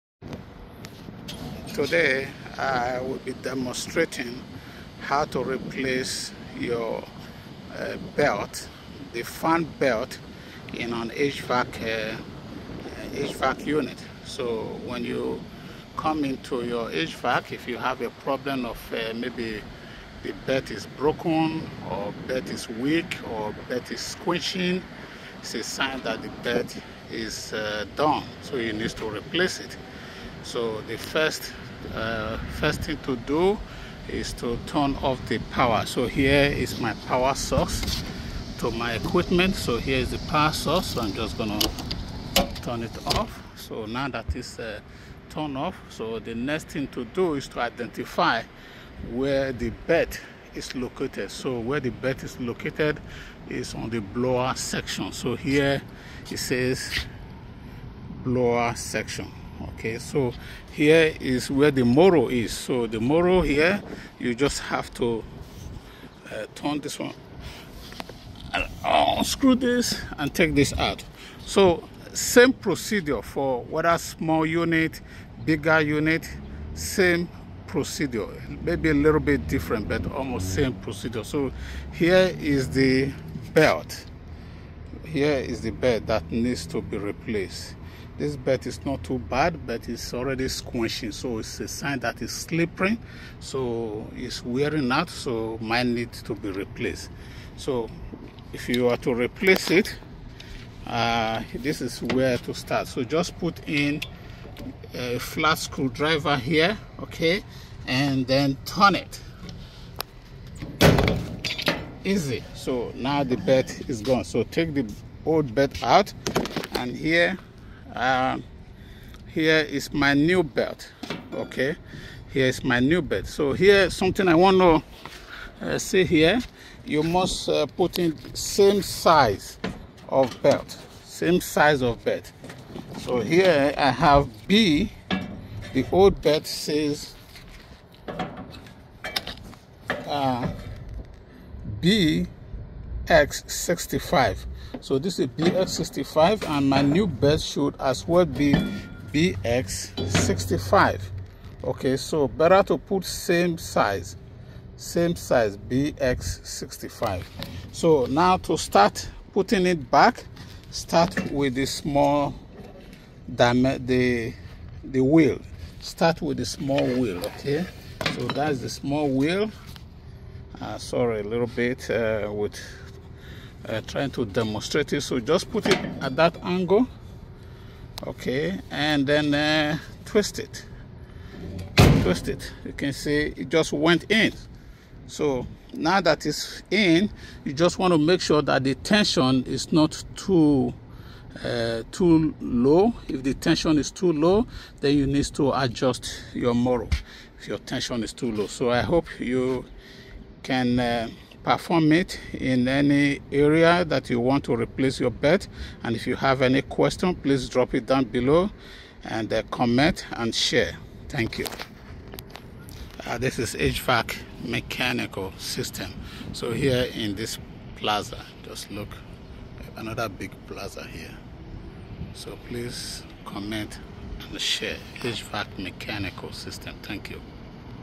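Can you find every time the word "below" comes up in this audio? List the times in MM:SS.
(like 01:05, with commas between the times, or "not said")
03:28.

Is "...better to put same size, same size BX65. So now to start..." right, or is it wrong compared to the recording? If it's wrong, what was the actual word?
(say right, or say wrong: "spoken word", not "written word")
right.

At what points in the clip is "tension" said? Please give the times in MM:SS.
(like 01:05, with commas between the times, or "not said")
03:08, 03:13, 03:17.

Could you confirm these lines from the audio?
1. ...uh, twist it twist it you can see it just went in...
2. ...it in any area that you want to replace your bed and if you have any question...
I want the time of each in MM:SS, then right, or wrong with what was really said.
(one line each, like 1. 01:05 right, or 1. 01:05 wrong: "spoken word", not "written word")
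1. 02:59 right
2. 03:21 right.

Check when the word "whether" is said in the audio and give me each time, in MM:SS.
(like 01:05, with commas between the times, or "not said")
01:13.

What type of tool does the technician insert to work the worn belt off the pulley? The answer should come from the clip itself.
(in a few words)
Flat screwdriver.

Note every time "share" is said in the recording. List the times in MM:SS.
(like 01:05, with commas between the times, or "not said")
03:30, 03:44.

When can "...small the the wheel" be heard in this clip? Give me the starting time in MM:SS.
02:41.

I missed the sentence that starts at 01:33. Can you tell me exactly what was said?
So it's wearing out, so mine needs to be replaced.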